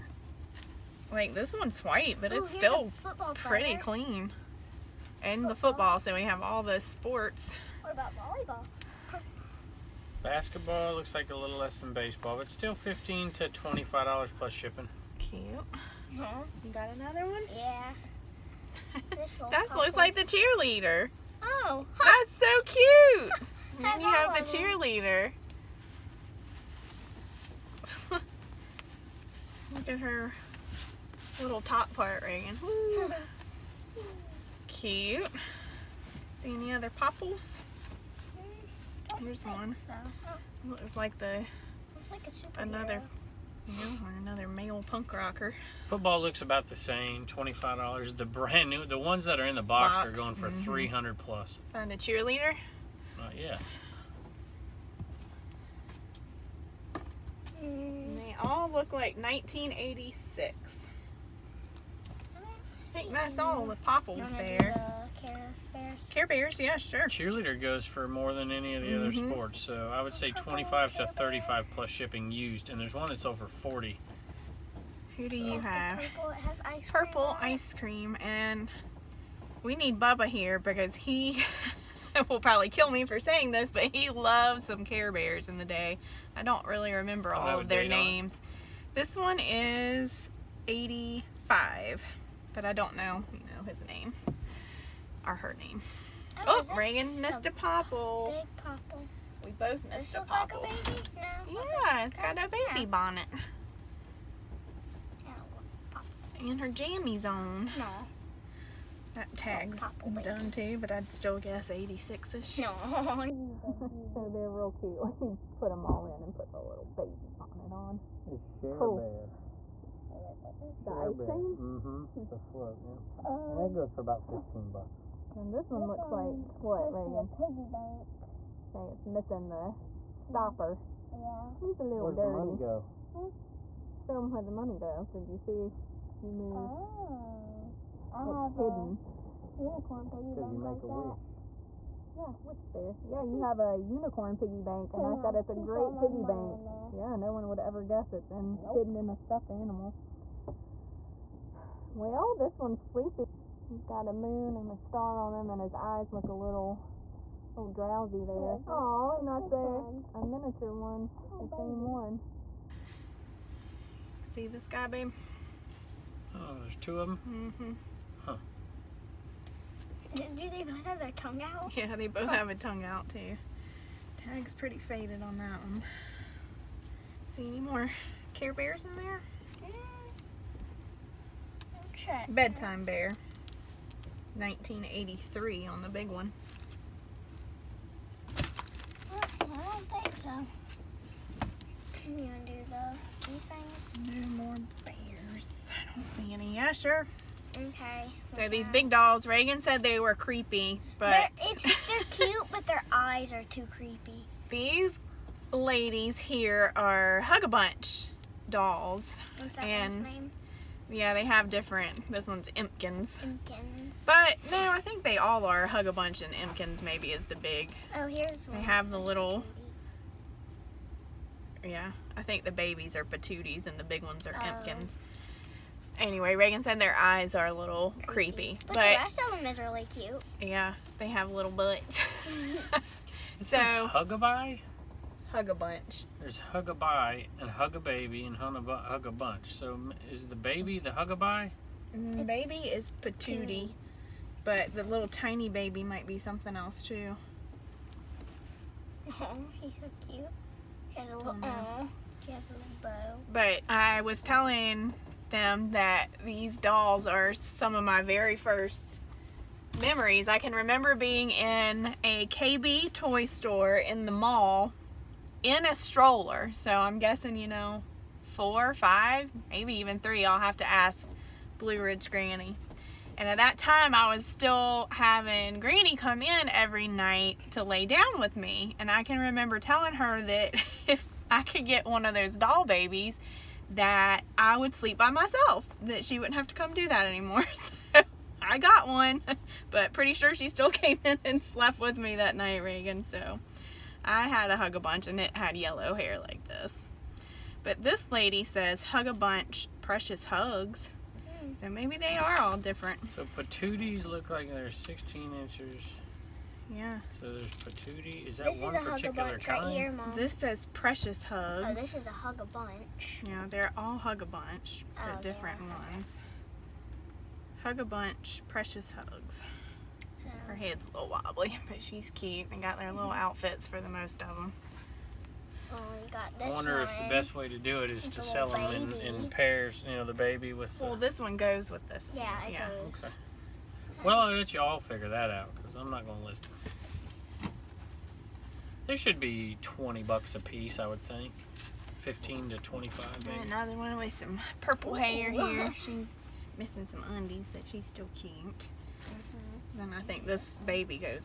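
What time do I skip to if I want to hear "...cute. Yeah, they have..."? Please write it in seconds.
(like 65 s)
229 s.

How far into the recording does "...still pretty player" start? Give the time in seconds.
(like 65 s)
2 s.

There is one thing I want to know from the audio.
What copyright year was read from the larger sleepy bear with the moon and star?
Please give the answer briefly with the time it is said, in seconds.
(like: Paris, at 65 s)
1983, at 184 s.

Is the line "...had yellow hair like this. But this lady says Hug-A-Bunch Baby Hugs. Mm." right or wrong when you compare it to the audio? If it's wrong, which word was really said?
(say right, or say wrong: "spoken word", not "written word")
wrong: "Precious", not "Baby".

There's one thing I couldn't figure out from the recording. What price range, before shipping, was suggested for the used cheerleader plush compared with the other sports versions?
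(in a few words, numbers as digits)
$25 to $35.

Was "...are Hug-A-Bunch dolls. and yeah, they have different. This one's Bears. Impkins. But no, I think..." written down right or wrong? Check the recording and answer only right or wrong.
wrong.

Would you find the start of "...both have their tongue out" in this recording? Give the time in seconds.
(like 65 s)
170 s.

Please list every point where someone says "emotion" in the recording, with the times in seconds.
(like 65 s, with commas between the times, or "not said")
not said.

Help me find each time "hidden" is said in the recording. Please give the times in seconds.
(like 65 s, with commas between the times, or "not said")
138 s, 148 s.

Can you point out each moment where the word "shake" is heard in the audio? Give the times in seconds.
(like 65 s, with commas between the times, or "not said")
not said.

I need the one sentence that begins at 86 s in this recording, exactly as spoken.
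I don't really remember all of their names.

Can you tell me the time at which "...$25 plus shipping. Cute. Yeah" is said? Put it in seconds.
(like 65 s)
13 s.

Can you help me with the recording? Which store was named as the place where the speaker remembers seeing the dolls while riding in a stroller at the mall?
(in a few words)
KB toy store.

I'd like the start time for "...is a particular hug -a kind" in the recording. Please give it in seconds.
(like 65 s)
308 s.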